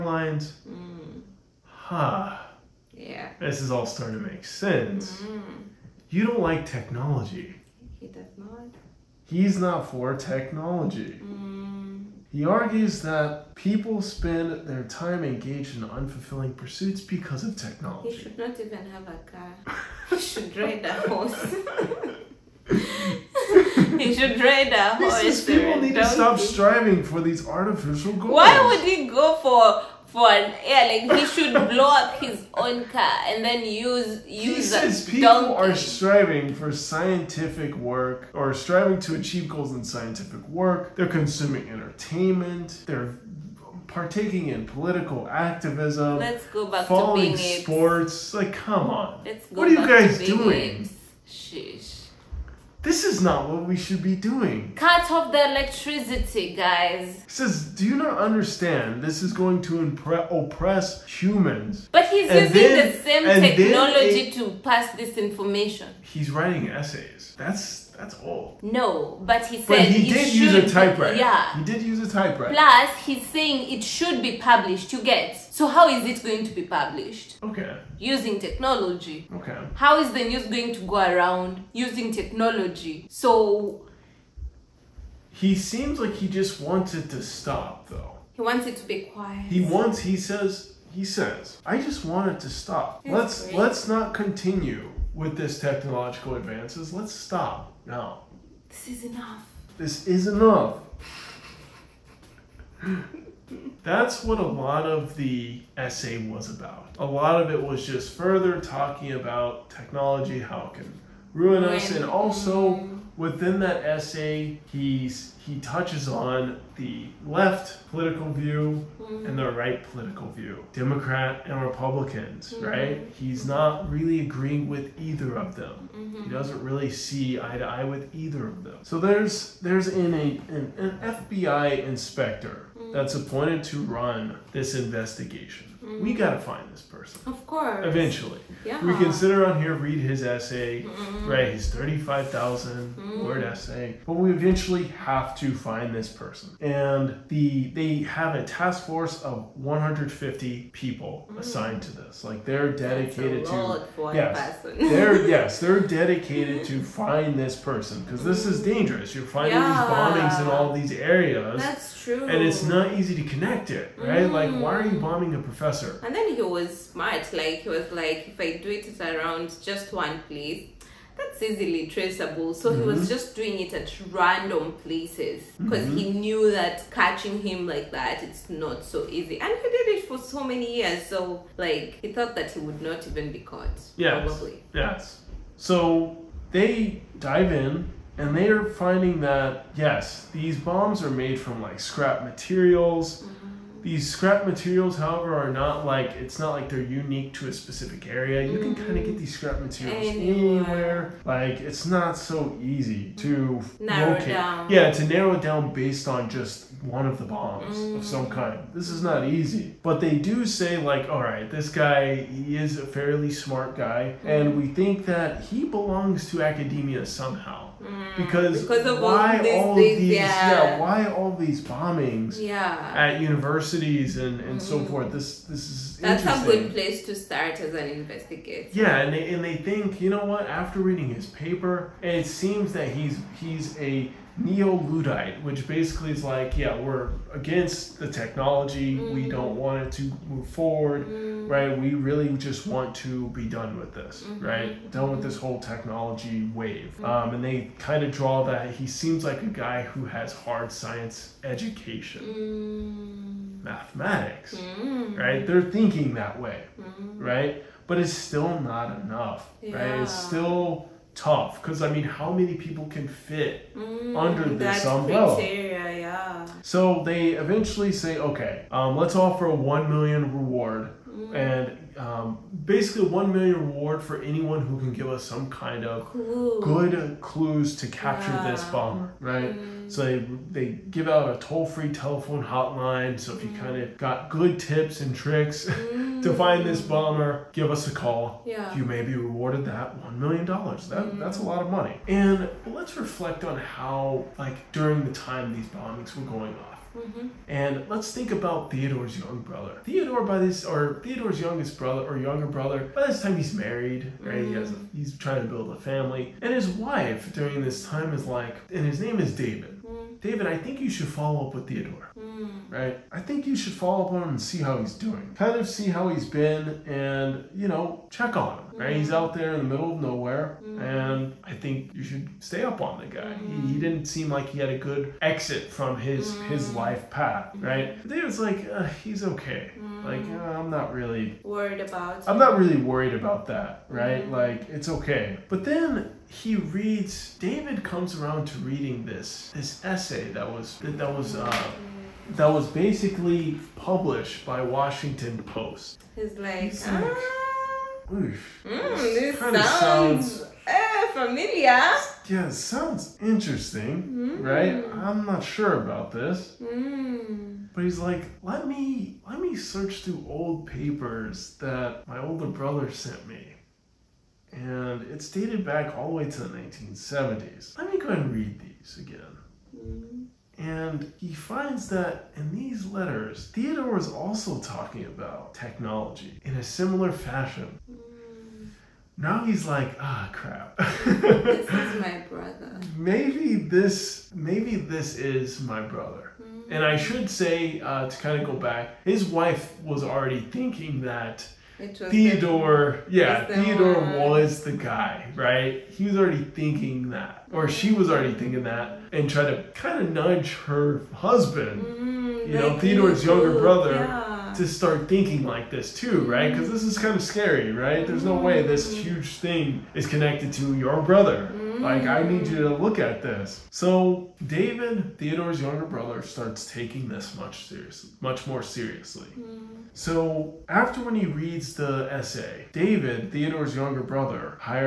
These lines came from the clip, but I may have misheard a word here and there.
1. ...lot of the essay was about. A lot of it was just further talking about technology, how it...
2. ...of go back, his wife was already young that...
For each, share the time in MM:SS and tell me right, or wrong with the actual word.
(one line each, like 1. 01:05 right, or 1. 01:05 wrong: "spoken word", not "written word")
1. 01:44 right
2. 06:28 wrong: "thinking", not "young".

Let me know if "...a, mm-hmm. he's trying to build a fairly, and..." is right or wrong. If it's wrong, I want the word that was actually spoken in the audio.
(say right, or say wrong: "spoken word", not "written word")
wrong: "family", not "fairly".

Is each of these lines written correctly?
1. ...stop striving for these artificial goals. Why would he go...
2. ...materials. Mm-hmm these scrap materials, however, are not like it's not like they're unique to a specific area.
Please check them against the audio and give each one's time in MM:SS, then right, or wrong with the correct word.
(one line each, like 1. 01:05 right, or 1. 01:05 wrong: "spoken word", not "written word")
1. 00:26 right
2. 03:12 right.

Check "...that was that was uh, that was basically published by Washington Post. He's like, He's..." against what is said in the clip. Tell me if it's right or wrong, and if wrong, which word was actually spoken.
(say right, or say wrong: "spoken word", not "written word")
right.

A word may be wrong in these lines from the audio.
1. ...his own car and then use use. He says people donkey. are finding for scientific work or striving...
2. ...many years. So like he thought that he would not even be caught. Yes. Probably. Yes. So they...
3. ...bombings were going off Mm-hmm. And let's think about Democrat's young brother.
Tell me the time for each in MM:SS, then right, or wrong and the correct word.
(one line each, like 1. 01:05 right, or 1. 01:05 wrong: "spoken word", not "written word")
1. 00:32 wrong: "striving", not "finding"
2. 03:00 right
3. 04:55 wrong: "Theodore", not "Democrat".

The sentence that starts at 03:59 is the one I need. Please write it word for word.
we don't want it to move forward mm.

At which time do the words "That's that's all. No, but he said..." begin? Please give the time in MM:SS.
01:07.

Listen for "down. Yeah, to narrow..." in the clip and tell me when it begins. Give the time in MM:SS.
03:24.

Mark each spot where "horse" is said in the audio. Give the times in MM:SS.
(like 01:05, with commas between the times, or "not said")
00:20, 00:24.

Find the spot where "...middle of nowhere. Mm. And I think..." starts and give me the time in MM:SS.
05:19.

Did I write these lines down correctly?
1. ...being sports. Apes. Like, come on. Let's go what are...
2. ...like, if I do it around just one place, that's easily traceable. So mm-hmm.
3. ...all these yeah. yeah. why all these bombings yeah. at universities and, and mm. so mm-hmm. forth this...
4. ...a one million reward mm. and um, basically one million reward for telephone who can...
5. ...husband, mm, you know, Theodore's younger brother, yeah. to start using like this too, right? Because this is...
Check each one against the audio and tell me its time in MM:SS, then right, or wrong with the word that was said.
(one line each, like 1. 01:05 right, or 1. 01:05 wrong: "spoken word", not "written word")
1. 00:47 right
2. 02:47 right
3. 03:39 right
4. 04:29 wrong: "anyone", not "telephone"
5. 06:41 wrong: "thinking", not "using".